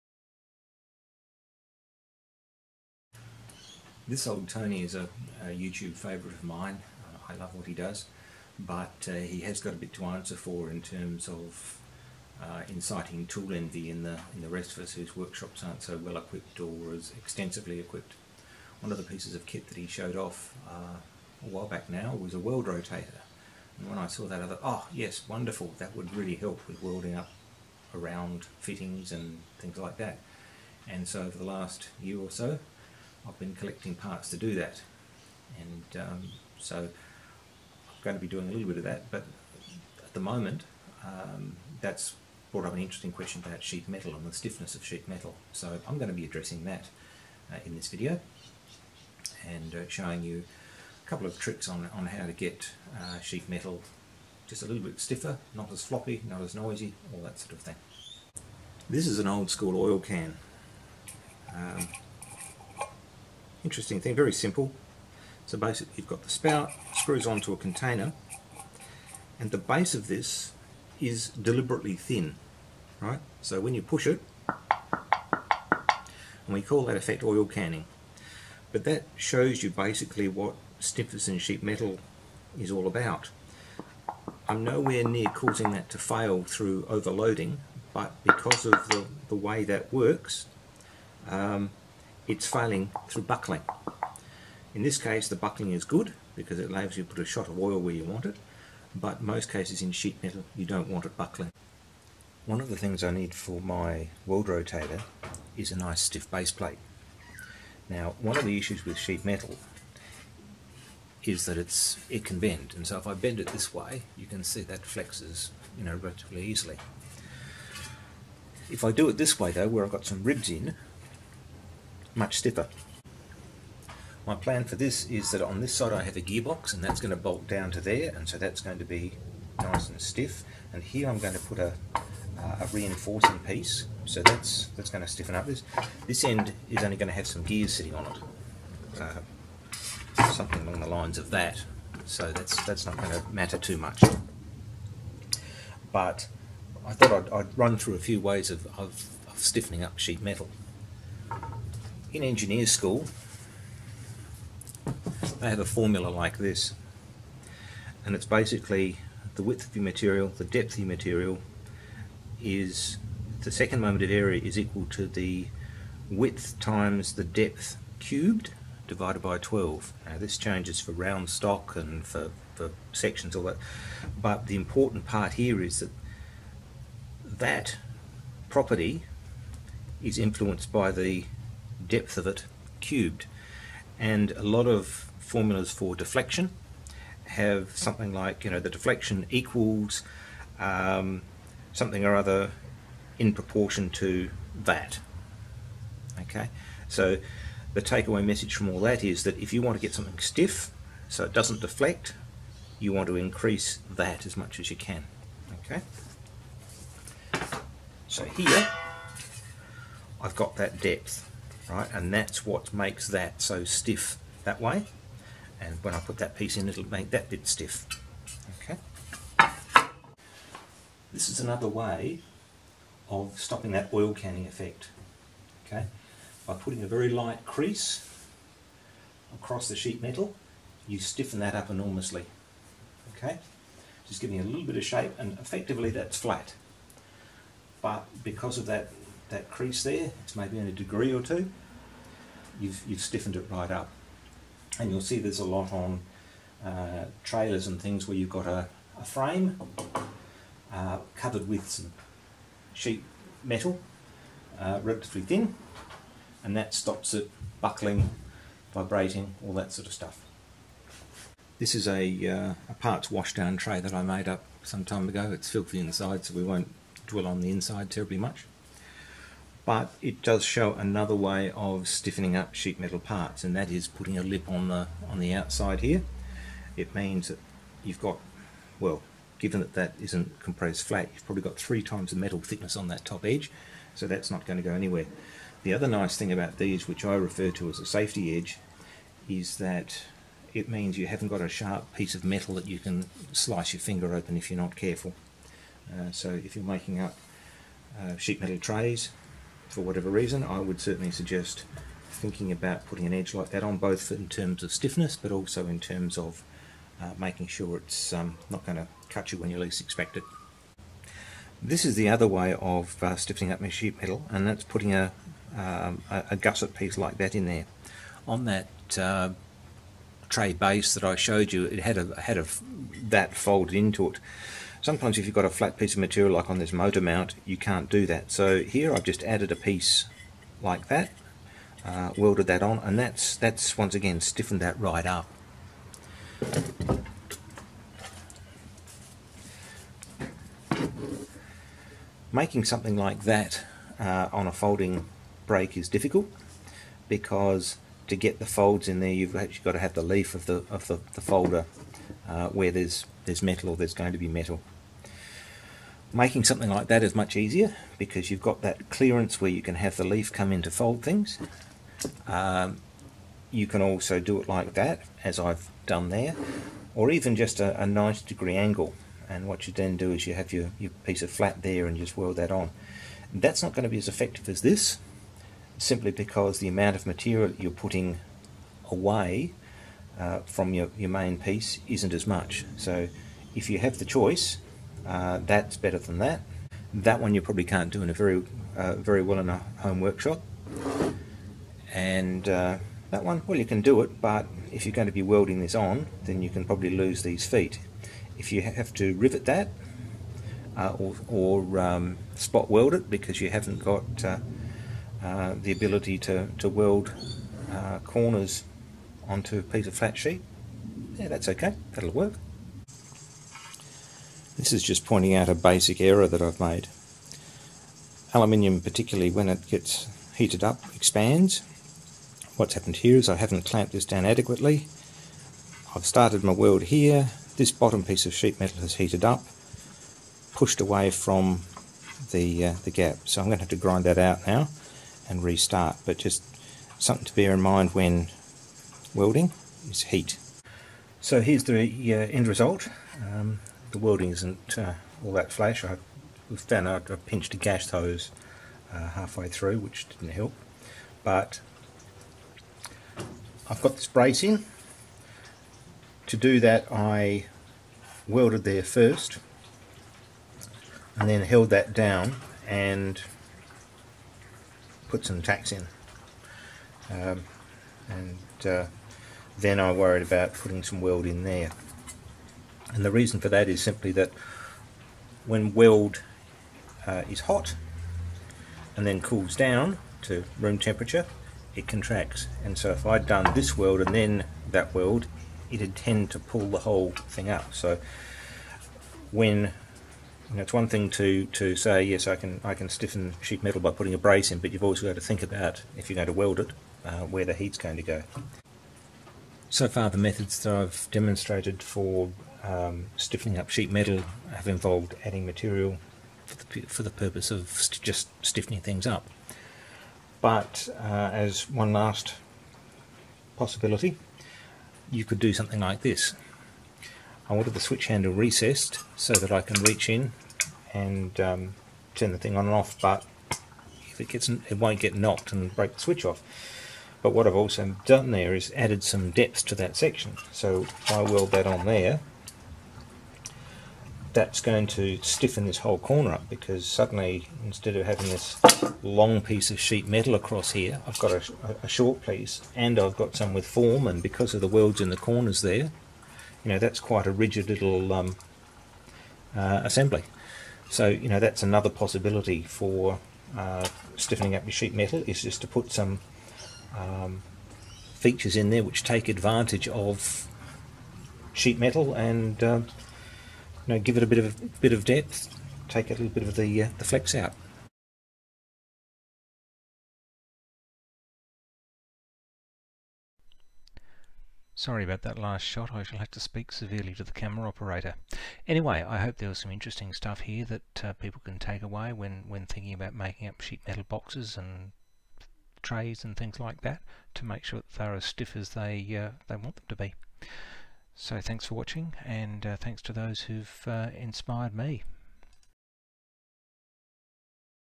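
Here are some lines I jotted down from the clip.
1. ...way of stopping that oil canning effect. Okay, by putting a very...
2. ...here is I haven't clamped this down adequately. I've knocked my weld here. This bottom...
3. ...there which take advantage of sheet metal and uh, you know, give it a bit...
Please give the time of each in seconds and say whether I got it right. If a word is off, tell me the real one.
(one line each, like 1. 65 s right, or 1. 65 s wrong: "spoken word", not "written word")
1. 221 s right
2. 422 s wrong: "started", not "knocked"
3. 558 s right.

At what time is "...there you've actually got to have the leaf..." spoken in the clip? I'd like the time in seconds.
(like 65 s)
348 s.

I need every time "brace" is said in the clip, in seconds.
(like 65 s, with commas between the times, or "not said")
454 s, 494 s.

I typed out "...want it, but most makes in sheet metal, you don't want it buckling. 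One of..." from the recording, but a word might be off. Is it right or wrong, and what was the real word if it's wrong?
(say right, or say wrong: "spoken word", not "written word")
wrong: "cases", not "makes".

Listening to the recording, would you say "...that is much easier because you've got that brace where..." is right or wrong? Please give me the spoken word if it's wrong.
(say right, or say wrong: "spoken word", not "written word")
wrong: "clearance", not "brace".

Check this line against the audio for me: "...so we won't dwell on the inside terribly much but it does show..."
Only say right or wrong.
right.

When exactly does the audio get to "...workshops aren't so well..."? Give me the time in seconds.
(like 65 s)
15 s.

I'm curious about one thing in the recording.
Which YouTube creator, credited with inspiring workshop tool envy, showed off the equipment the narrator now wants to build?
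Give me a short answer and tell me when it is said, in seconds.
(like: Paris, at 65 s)
This Old Tony, at 4 s.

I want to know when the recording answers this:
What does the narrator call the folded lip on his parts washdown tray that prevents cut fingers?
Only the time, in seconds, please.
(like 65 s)
287 s.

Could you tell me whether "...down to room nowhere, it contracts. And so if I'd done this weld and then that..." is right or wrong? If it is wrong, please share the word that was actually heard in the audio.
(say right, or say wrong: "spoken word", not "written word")
wrong: "temperature", not "nowhere".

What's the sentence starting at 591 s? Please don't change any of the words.
So thanks for watching and uh, thanks to those who've uh, inspired me.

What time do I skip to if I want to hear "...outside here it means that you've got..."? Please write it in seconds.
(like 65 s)
275 s.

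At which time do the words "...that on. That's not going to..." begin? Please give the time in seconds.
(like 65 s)
372 s.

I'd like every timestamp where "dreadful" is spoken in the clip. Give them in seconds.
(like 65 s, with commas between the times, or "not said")
not said.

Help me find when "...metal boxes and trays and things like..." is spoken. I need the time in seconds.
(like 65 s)
583 s.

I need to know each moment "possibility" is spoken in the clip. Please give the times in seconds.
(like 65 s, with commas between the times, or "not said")
513 s, 551 s.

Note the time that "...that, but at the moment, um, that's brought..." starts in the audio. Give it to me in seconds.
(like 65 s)
38 s.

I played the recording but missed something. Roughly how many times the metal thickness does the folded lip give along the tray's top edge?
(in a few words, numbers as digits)
3.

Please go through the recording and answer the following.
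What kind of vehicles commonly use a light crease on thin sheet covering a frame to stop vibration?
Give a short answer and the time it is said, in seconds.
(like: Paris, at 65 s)
trailers, at 247 s.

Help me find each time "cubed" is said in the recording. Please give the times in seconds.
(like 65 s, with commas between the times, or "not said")
167 s, 182 s.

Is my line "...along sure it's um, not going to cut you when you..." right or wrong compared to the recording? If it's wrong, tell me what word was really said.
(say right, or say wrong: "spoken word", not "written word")
wrong: "making", not "along".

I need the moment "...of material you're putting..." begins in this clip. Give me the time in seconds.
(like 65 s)
376 s.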